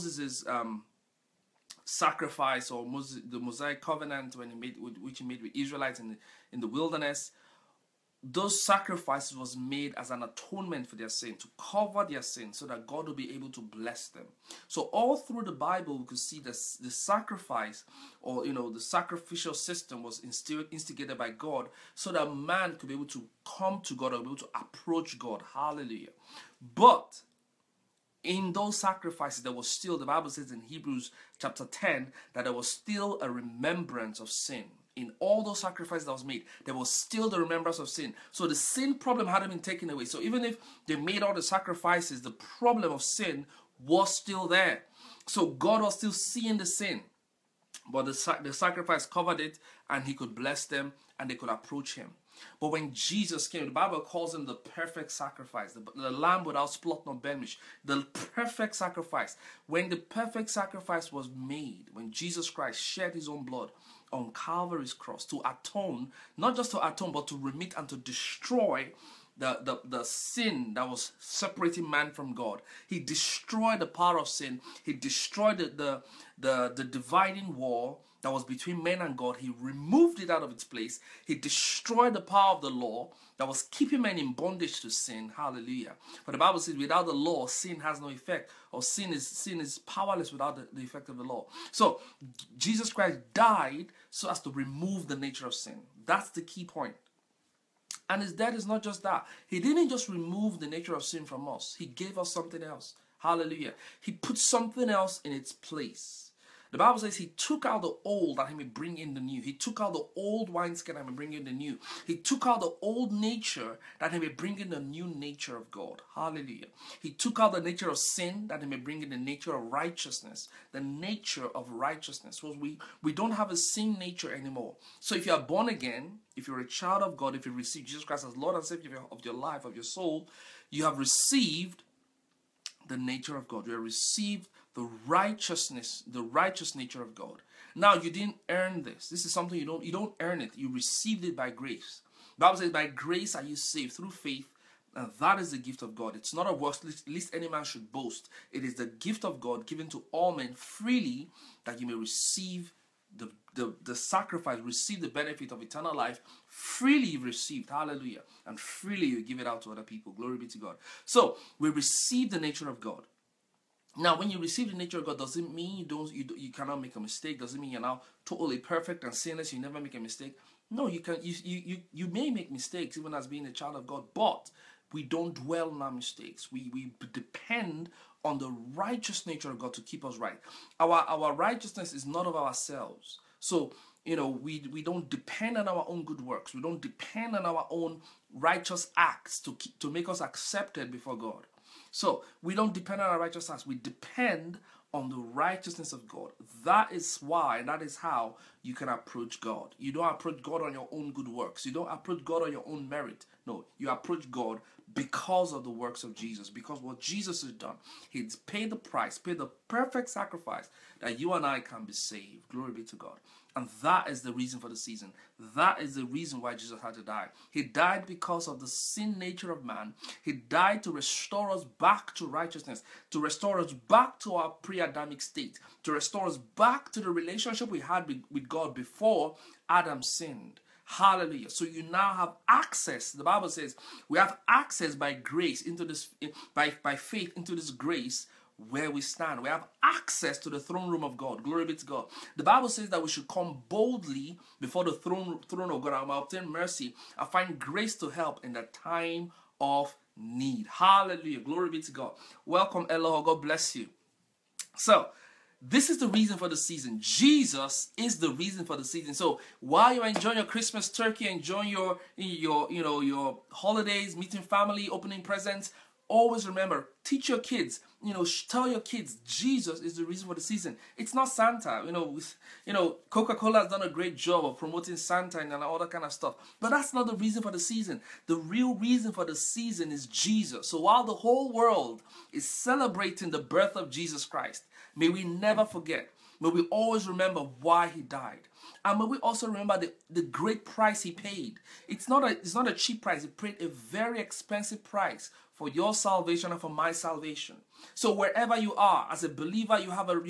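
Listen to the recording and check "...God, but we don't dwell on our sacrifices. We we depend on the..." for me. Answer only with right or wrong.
wrong.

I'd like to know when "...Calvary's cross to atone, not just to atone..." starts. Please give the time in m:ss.
1:04.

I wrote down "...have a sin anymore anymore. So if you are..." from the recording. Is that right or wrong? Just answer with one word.
wrong.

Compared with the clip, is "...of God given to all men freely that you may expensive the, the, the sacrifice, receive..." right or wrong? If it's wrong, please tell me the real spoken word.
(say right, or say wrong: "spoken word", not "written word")
wrong: "receive", not "expensive".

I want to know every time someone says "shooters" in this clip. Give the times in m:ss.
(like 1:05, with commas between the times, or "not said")
not said.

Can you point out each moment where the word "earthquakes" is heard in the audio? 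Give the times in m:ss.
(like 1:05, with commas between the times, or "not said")
not said.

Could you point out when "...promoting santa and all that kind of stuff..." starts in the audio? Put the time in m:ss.
4:34.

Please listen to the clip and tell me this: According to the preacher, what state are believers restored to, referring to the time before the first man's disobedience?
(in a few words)
pre Adamic state.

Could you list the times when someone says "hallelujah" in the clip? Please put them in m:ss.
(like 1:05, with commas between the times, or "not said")
0:25, 1:25, 1:43, 1:56, 2:37, 3:50, 4:10.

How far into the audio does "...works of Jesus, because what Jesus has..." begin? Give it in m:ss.
3:25.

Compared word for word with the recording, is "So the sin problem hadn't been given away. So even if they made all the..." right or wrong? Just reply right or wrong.
wrong.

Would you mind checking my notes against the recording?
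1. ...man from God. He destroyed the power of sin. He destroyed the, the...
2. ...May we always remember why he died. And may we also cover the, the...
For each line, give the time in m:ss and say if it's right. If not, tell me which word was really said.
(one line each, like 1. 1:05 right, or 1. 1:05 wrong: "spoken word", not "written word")
1. 1:11 right
2. 4:46 wrong: "remember", not "cover".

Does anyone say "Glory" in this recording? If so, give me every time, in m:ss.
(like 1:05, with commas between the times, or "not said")
2:40, 3:32, 4:01, 4:11.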